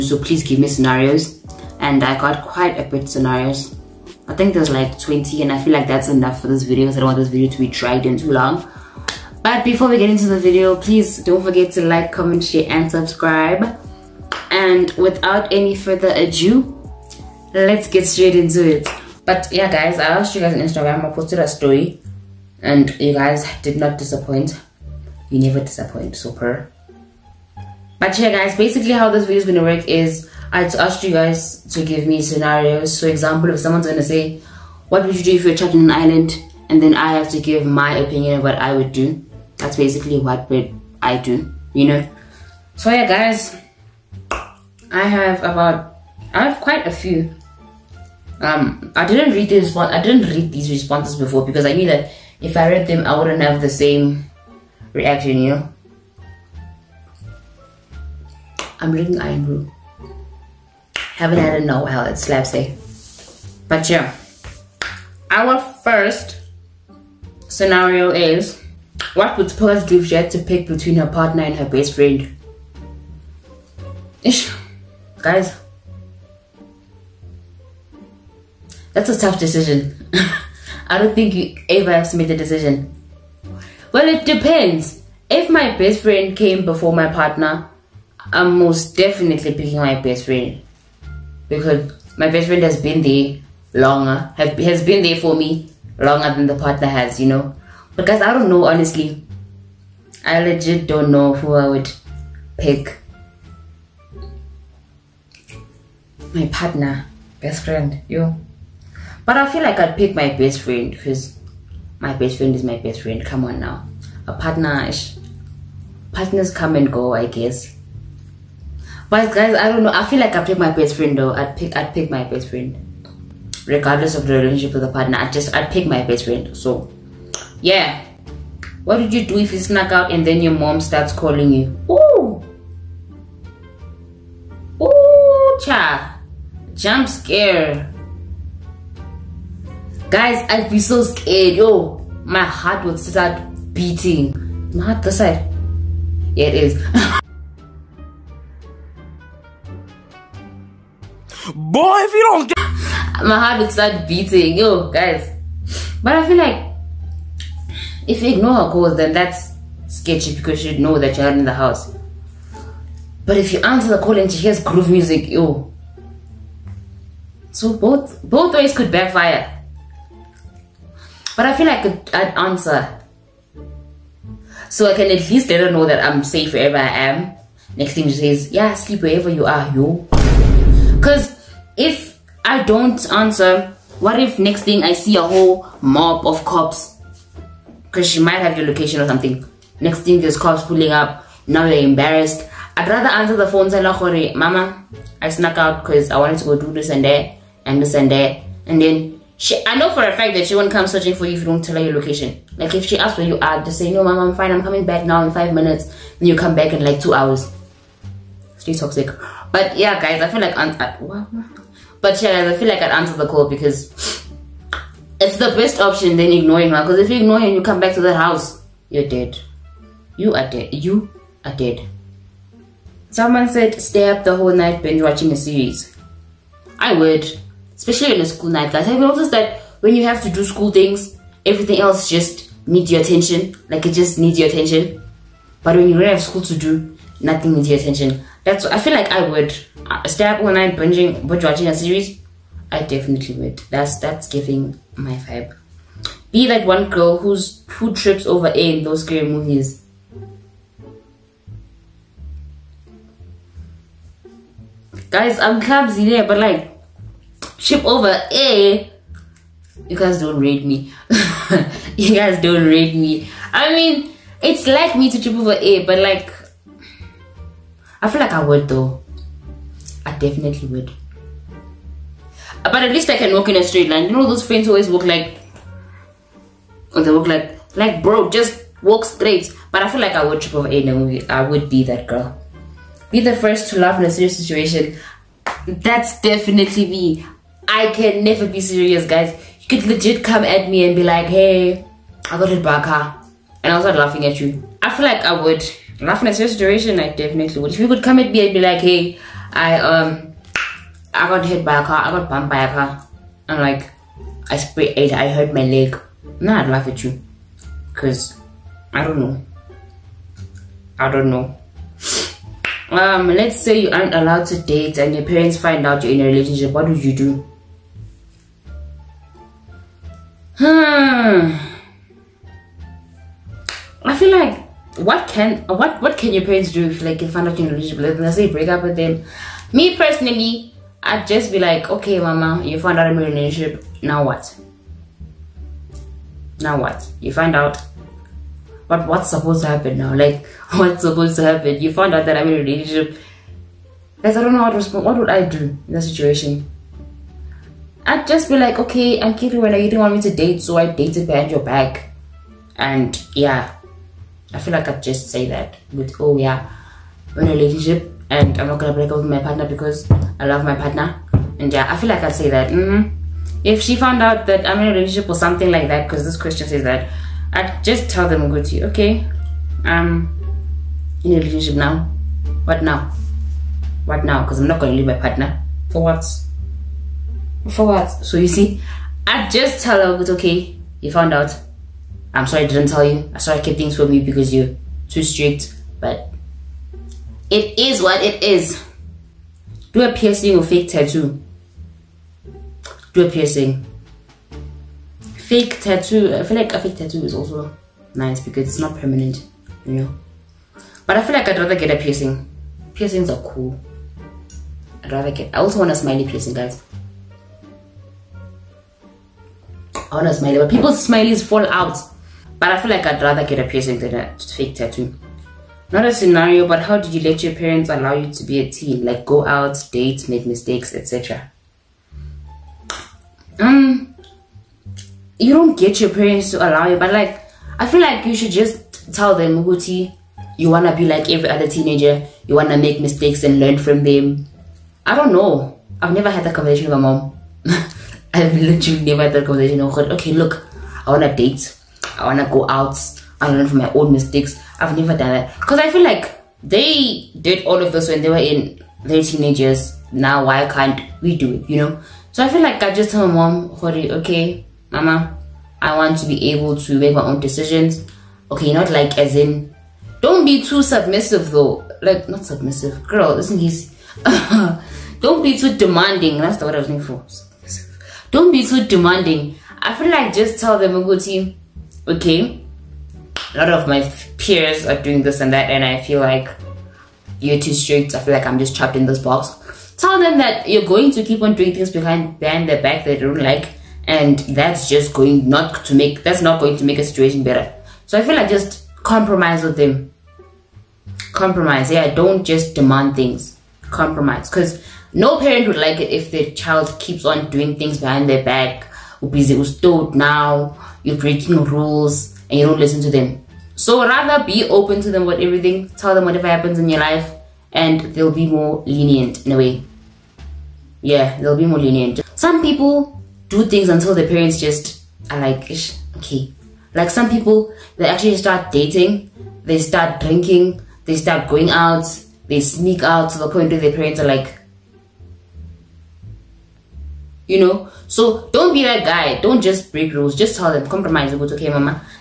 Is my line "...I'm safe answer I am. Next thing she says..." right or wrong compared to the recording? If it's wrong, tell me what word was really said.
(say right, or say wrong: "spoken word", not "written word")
wrong: "wherever", not "answer".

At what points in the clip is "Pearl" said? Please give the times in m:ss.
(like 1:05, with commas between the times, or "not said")
1:09.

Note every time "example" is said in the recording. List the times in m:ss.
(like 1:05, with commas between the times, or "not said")
0:33.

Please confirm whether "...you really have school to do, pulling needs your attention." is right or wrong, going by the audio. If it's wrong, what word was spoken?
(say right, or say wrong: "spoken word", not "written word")
wrong: "nothing", not "pulling".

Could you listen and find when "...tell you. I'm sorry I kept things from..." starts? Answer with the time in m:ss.
6:22.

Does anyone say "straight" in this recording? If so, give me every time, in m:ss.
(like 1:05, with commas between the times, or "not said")
0:18, 4:33, 4:39.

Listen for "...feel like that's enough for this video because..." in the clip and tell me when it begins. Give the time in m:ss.
0:05.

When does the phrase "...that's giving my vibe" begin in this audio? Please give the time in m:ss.
4:03.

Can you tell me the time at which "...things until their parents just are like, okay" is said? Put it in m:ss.
8:33.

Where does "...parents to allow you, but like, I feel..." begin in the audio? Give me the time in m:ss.
7:06.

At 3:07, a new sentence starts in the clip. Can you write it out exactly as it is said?
Because she might have your location or something.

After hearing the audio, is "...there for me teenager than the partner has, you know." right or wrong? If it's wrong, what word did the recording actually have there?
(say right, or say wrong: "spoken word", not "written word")
wrong: "longer", not "teenager".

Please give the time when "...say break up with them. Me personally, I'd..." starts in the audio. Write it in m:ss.
5:28.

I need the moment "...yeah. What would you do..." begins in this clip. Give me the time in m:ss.
2:07.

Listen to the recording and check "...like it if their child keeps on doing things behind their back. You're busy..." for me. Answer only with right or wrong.
right.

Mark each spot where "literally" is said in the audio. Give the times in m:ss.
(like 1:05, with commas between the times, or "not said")
7:18.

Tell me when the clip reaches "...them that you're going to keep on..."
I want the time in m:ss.
8:00.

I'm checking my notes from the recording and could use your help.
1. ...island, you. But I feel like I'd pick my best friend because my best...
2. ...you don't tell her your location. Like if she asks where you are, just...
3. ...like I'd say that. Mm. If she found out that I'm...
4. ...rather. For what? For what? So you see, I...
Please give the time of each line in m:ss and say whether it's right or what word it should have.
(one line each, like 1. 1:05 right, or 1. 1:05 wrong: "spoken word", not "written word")
1. 1:47 wrong: "friend", not "island"
2. 3:21 right
3. 6:02 right
4. 6:15 wrong: "partner", not "rather".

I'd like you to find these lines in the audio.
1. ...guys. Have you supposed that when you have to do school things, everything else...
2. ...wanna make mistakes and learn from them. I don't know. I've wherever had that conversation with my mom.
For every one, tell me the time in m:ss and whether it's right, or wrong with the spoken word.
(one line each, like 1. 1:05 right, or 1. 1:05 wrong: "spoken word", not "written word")
1. 3:48 wrong: "noticed", not "supposed"
2. 7:12 wrong: "never", not "wherever".